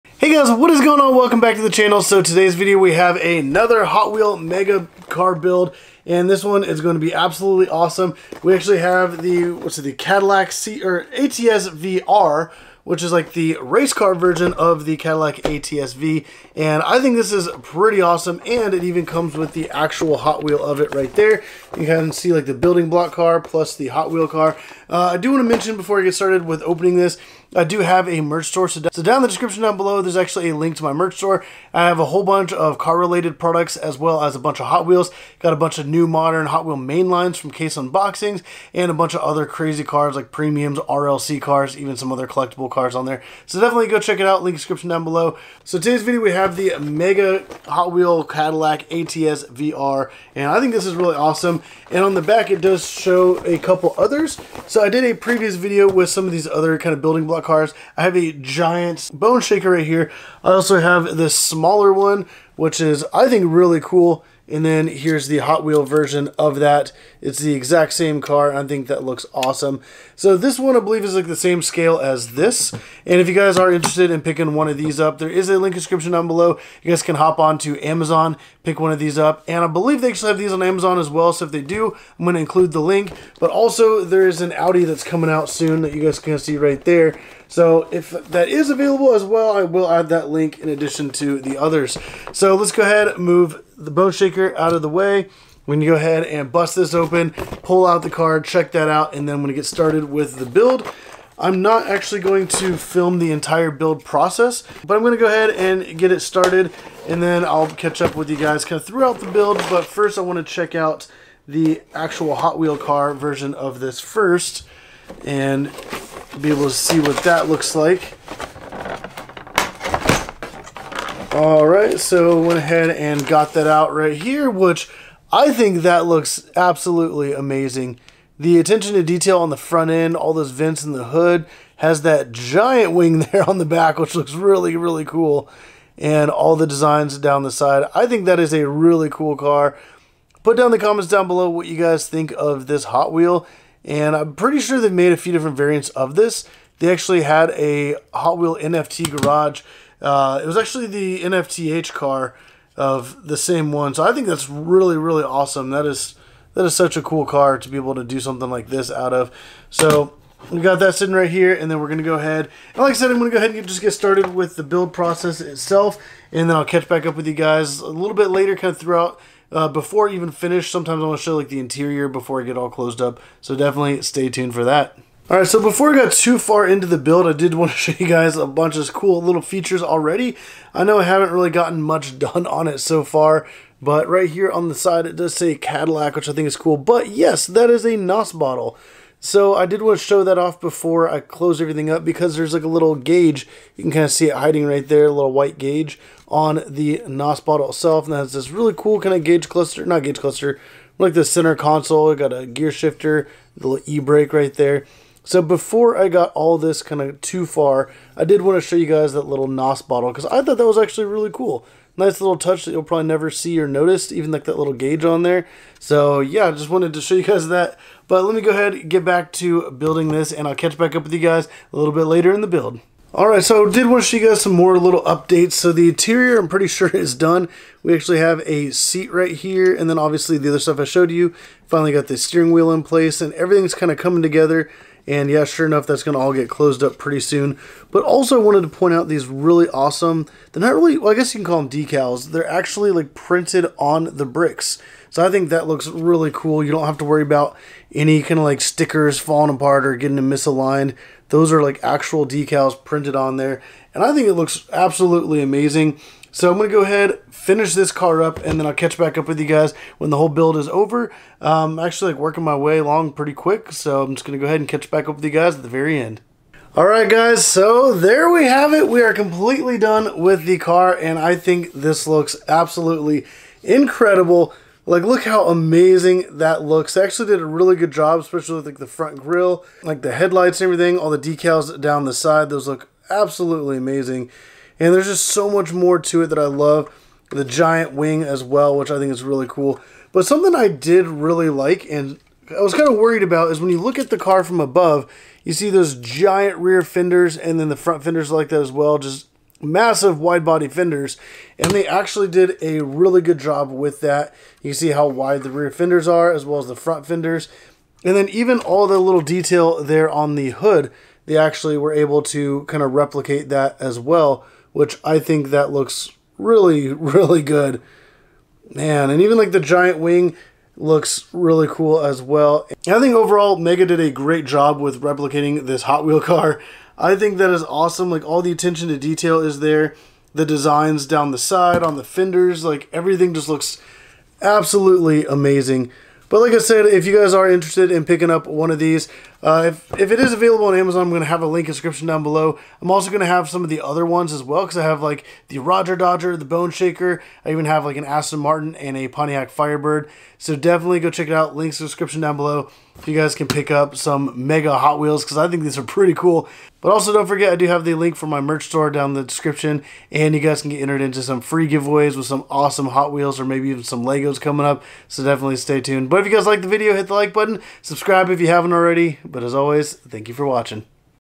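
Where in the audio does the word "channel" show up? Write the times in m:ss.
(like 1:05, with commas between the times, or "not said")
0:01.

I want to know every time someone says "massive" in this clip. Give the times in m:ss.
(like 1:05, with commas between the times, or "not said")
4:59.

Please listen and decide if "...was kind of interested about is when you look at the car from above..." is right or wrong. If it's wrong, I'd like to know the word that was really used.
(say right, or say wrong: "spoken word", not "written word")
wrong: "worried", not "interested".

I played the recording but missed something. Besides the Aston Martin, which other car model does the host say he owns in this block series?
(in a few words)
Pontiac Firebird.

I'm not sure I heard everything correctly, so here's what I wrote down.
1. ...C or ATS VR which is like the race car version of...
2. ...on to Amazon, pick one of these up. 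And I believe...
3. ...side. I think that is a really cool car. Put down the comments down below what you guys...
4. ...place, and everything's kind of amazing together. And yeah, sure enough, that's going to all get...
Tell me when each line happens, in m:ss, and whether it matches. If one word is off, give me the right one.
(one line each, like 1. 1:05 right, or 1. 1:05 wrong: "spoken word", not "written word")
1. 0:10 right
2. 1:17 right
3. 2:17 right
4. 3:52 wrong: "coming", not "amazing".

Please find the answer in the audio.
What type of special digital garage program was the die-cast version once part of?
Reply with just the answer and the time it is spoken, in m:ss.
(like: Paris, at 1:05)
NFT garage, at 2:28.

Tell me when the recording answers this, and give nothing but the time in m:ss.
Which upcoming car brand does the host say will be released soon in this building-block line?
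1:24.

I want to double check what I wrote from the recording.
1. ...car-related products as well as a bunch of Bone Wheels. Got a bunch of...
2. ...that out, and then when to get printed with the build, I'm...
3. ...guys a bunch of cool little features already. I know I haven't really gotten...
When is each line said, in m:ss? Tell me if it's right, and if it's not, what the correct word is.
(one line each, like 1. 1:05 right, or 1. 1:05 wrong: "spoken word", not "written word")
1. 0:32 wrong: "Hot", not "Bone"
2. 1:38 wrong: "started", not "printed"
3. 2:58 right.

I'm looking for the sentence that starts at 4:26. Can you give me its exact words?
Alright guys, so there we have it.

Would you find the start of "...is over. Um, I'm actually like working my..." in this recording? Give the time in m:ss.
4:20.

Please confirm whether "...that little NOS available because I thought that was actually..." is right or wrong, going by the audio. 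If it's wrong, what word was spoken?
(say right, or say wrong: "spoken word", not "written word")
wrong: "bottle", not "available".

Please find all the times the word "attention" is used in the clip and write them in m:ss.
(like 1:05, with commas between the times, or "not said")
2:08, 5:28.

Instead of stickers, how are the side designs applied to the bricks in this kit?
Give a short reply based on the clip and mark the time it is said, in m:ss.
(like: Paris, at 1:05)
printed on the bricks, at 4:03.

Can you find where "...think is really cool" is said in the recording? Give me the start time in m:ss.
4:48.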